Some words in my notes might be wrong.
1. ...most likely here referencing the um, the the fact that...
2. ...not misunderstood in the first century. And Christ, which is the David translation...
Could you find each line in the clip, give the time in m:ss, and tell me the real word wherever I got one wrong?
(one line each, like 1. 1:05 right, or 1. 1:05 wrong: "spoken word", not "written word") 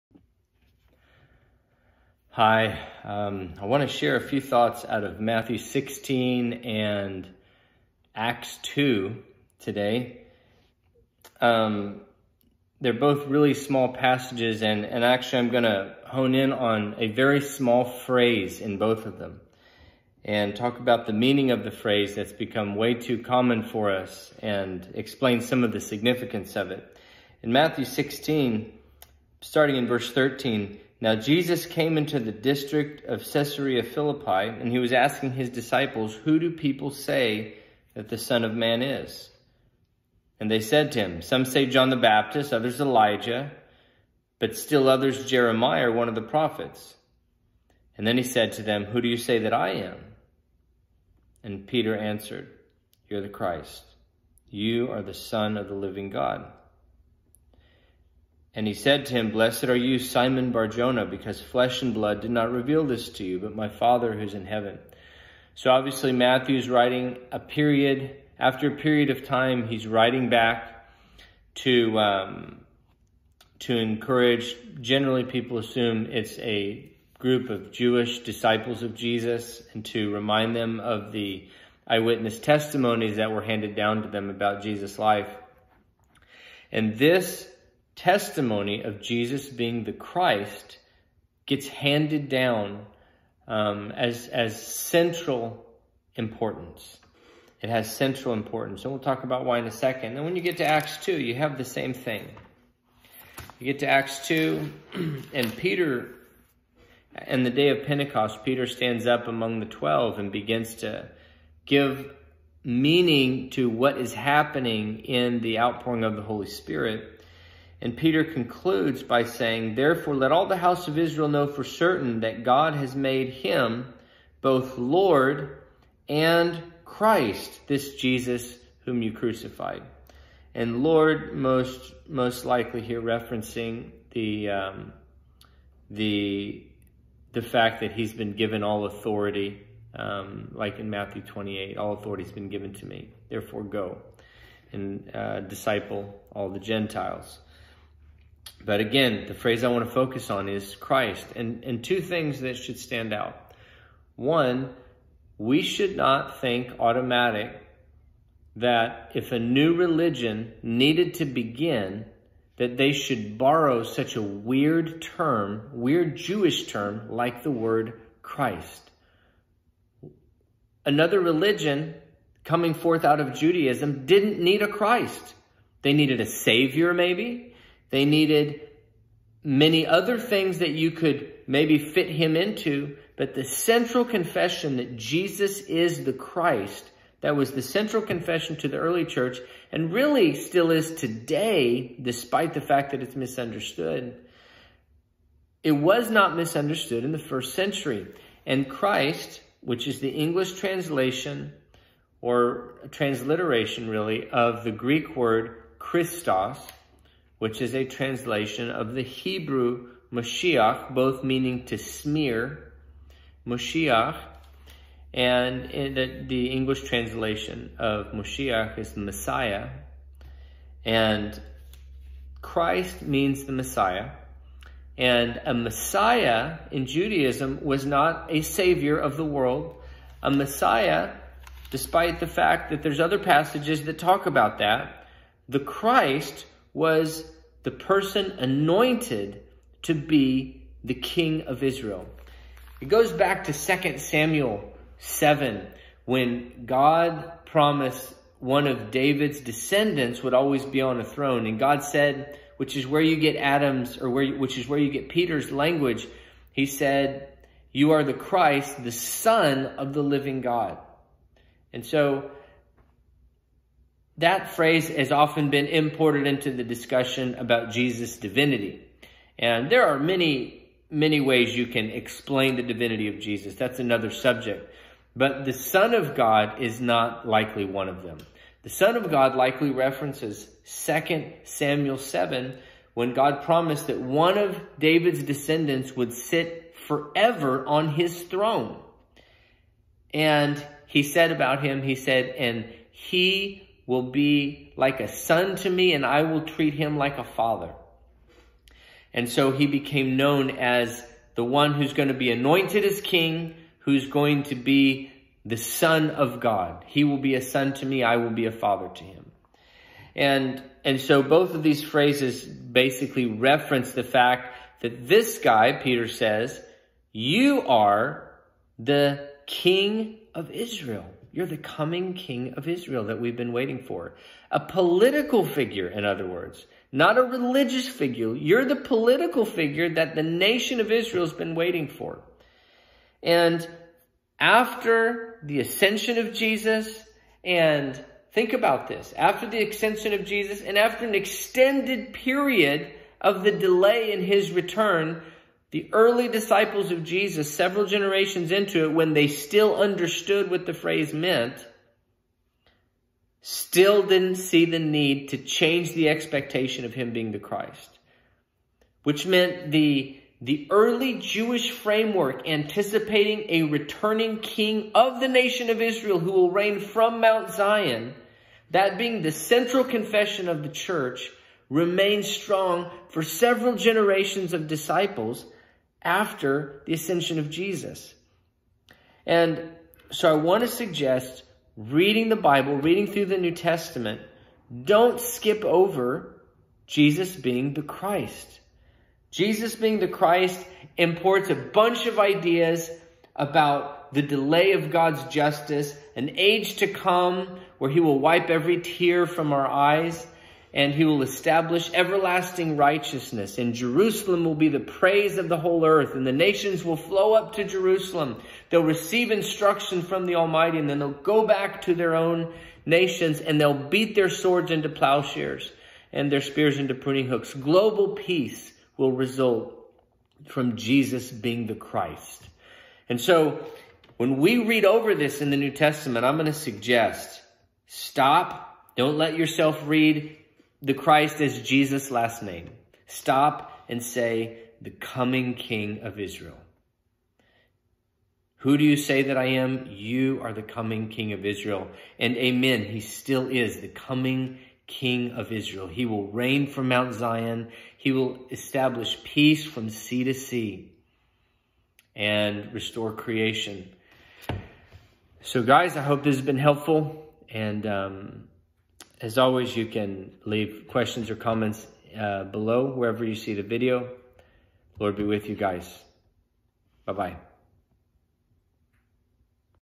1. 2:12 right
2. 3:16 wrong: "English", not "David".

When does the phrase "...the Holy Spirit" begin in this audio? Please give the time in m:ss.
1:56.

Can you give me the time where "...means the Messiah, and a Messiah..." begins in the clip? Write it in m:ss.
3:43.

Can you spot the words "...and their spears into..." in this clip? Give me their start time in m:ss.
6:56.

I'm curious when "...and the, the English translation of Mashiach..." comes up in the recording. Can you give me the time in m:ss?
3:35.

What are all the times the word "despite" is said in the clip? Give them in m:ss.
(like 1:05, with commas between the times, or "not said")
3:12, 3:51.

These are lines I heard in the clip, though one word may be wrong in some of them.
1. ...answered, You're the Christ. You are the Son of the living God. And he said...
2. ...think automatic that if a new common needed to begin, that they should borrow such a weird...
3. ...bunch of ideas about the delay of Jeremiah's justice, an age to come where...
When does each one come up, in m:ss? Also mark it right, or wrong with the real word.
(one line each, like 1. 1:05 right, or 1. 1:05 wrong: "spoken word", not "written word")
1. 0:51 right
2. 2:36 wrong: "religion", not "common"
3. 6:31 wrong: "God", not "Jeremiah".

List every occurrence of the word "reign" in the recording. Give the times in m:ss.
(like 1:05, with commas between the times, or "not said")
6:06, 7:26.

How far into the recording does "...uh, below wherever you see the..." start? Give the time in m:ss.
7:42.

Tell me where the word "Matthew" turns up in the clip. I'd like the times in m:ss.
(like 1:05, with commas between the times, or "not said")
0:05, 0:27, 1:06, 2:20.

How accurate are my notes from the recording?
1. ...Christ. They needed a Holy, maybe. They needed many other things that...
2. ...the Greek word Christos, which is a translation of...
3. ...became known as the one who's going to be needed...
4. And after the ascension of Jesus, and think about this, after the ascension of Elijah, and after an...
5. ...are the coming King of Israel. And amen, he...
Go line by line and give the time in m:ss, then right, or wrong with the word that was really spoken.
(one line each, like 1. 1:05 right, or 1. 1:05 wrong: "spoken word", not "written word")
1. 2:54 wrong: "Savior", not "Holy"
2. 3:24 right
3. 4:59 wrong: "anointed", not "needed"
4. 5:33 wrong: "Jesus", not "Elijah"
5. 7:20 right.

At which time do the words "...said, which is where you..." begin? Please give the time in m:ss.
4:11.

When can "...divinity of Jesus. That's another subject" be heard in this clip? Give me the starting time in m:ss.
4:32.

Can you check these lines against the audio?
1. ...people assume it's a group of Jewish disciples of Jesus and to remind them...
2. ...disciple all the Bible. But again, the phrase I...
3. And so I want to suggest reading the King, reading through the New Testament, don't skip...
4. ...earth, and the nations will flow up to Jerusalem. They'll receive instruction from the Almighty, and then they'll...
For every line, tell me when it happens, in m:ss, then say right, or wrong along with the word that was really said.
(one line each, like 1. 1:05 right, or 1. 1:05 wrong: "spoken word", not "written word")
1. 1:15 right
2. 2:25 wrong: "Gentiles", not "Bible"
3. 6:19 wrong: "Bible", not "King"
4. 6:45 right.